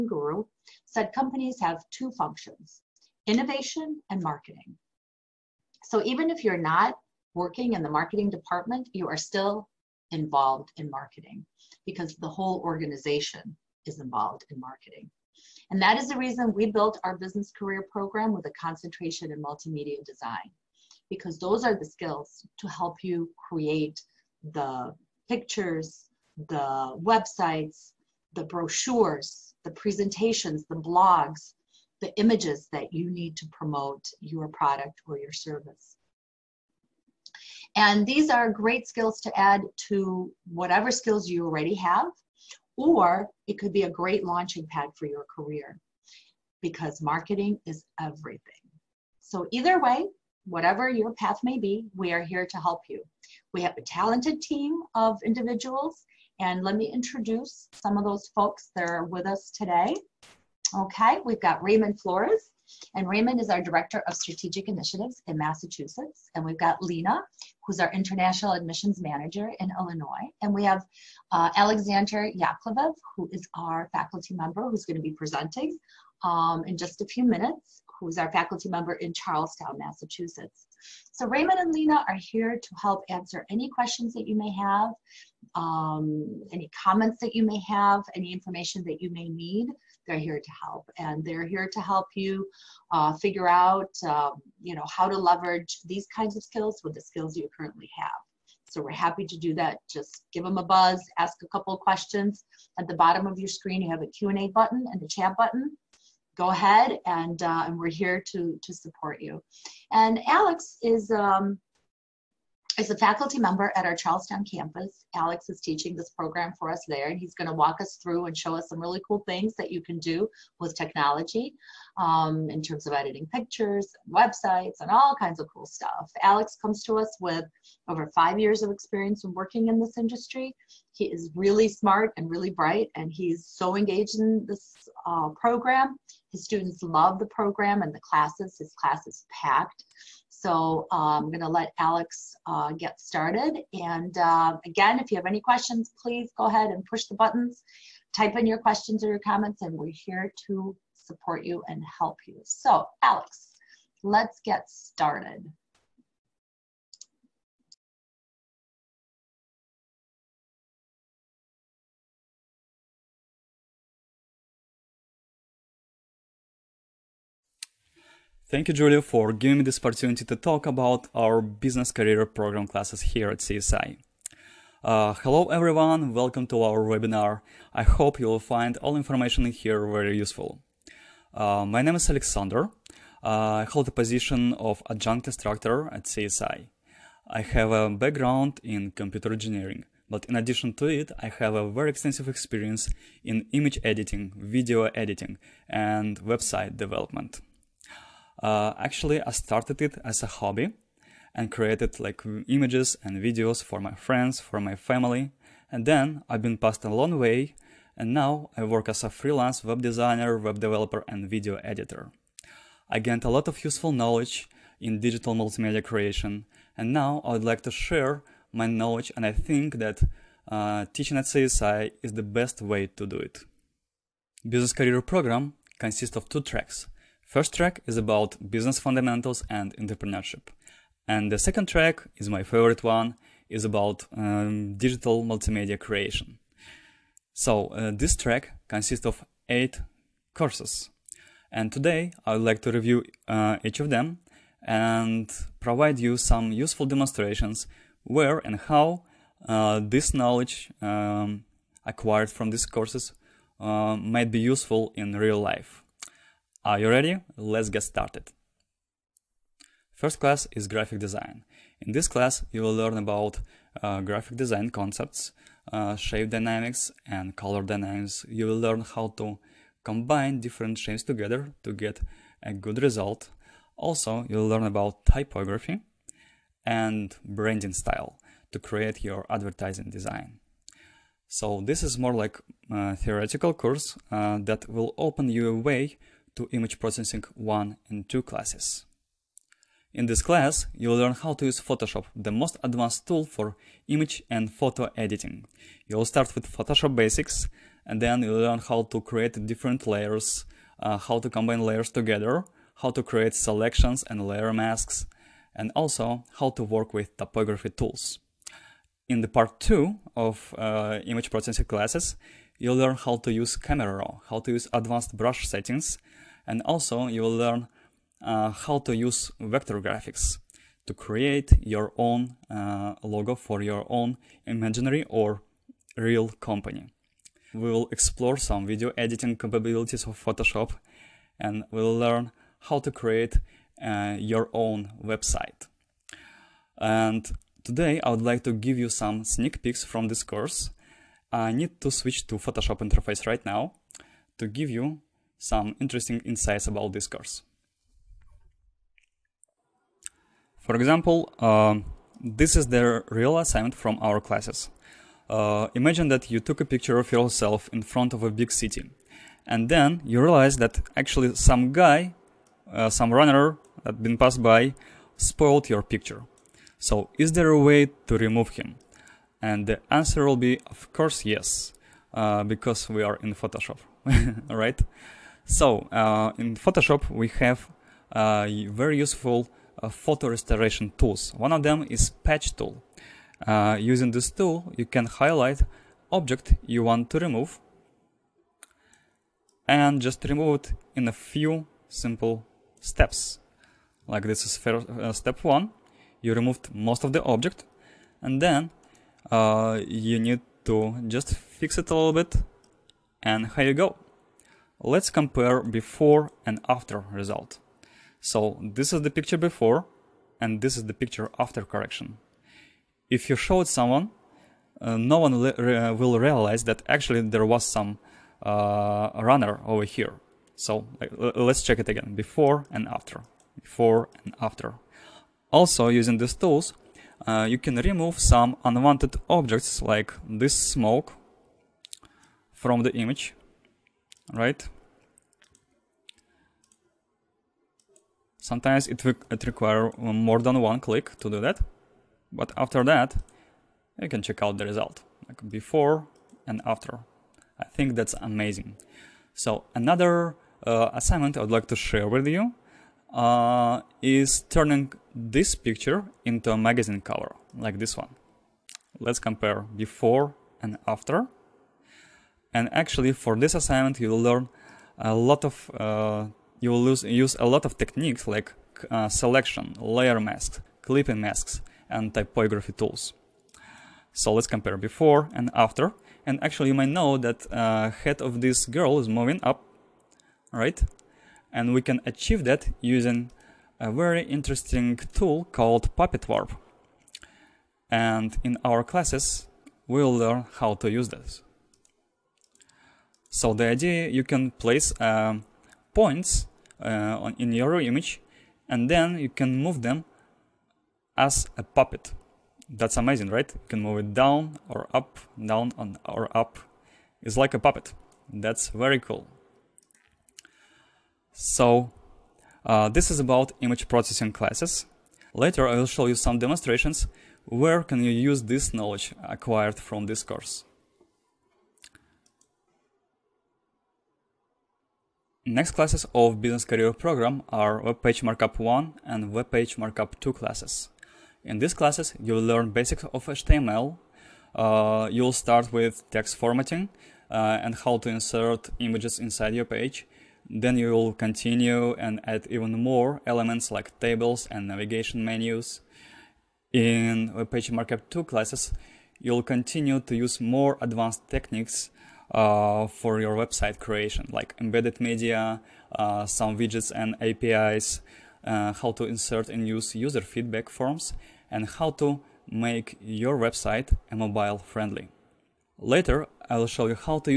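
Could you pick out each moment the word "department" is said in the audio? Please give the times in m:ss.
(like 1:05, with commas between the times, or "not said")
0:08.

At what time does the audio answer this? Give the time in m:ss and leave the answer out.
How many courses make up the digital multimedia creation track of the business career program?
3:59.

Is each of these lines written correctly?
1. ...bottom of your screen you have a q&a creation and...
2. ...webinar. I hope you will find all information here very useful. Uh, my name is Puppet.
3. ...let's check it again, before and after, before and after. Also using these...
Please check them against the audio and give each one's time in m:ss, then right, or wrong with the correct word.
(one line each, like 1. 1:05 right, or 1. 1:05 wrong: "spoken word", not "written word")
1. 1:42 wrong: "button", not "creation"
2. 2:56 wrong: "Alexander", not "Puppet"
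3. 7:01 right.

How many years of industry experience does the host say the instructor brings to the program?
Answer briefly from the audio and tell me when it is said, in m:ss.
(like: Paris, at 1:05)
5, at 2:08.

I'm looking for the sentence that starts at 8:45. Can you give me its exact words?
Next classes of Business Career Program are Web Page Markup 1 and Web Page Markup 2 classes.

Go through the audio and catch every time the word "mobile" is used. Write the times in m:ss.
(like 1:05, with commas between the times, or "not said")
9:24.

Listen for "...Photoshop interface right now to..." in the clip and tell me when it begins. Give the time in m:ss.
5:42.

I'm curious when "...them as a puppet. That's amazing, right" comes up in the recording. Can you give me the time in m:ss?
8:19.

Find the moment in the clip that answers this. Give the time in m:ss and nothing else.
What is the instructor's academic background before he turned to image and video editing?
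3:08.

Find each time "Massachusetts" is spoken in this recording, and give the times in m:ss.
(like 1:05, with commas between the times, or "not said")
1:05, 1:19.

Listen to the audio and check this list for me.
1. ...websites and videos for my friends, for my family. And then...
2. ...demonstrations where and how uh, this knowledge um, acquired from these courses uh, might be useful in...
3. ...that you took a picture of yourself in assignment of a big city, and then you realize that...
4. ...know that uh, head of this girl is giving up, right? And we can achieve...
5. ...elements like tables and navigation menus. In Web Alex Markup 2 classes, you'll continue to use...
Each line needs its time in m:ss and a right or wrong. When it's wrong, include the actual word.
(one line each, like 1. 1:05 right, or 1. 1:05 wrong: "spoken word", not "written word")
1. 3:22 wrong: "images", not "websites"
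2. 4:06 right
3. 5:56 wrong: "front", not "assignment"
4. 7:56 wrong: "moving", not "giving"
5. 9:03 wrong: "Page", not "Alex".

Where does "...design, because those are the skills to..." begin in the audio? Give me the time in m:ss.
0:20.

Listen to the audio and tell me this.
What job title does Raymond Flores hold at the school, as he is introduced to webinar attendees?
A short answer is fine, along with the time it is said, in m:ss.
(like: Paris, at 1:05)
Director of Strategic Initiatives, at 1:03.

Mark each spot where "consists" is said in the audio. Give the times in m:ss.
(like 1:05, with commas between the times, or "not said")
3:45, 3:58.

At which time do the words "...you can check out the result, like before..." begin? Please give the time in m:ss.
7:23.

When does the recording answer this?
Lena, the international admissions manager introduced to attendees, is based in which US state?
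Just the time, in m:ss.
1:09.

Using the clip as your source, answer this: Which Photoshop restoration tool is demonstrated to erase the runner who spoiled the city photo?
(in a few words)
Patch tool.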